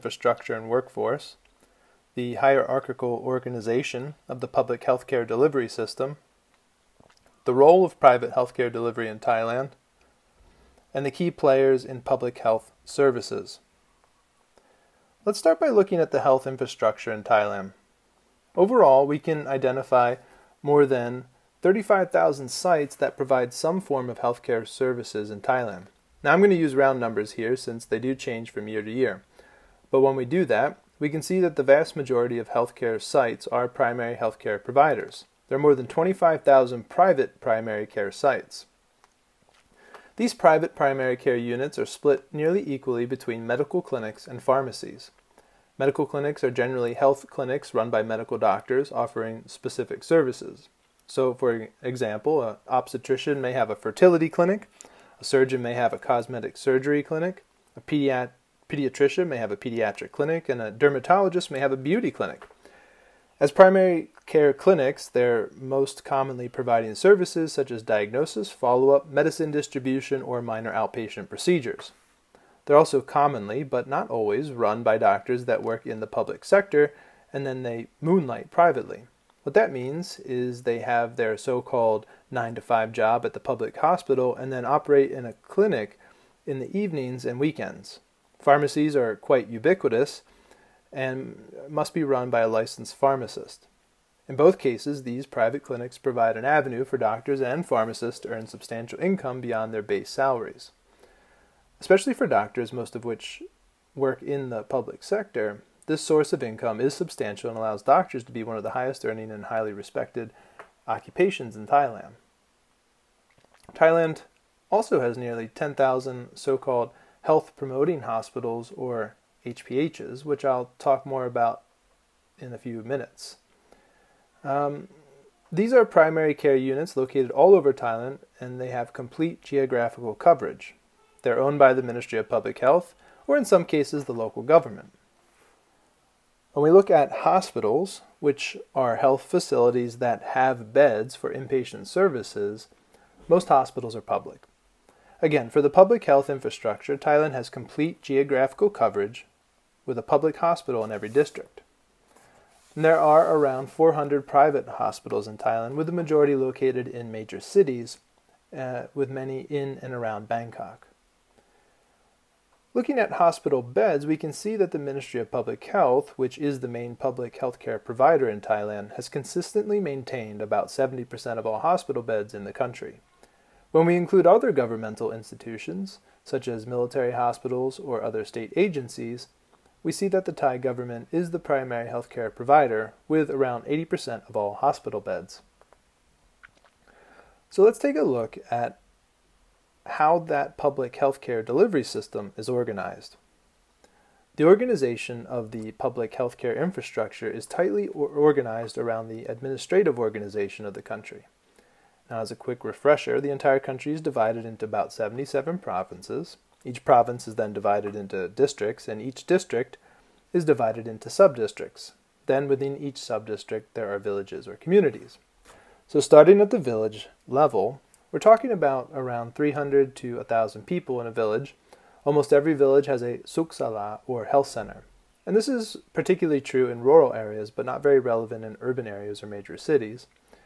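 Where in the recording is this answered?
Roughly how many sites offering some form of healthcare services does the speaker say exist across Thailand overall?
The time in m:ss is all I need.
0:21.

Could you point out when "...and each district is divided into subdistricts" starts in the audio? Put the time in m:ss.
3:28.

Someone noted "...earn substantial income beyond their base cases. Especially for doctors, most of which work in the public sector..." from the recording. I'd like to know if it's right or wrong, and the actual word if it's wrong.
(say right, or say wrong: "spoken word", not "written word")
wrong: "salaries", not "cases".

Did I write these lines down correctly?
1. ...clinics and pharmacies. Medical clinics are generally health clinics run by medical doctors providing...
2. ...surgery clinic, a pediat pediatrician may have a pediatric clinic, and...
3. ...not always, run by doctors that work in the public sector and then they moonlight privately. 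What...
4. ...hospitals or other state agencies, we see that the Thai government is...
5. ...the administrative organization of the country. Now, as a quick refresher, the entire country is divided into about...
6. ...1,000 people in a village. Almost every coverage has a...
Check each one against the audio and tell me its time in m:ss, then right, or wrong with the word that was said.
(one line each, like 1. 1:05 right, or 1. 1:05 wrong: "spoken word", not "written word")
1. 0:43 wrong: "offering", not "providing"
2. 0:56 right
3. 1:13 right
4. 2:57 right
5. 3:19 right
6. 3:40 wrong: "village", not "coverage".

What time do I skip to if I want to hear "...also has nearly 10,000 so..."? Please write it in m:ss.
1:54.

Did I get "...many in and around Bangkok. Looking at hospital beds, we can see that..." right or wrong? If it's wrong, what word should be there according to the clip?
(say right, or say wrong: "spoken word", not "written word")
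right.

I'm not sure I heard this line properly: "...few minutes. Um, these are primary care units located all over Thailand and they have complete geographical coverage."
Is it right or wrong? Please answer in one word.
right.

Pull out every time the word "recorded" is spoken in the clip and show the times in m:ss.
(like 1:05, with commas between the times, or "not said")
not said.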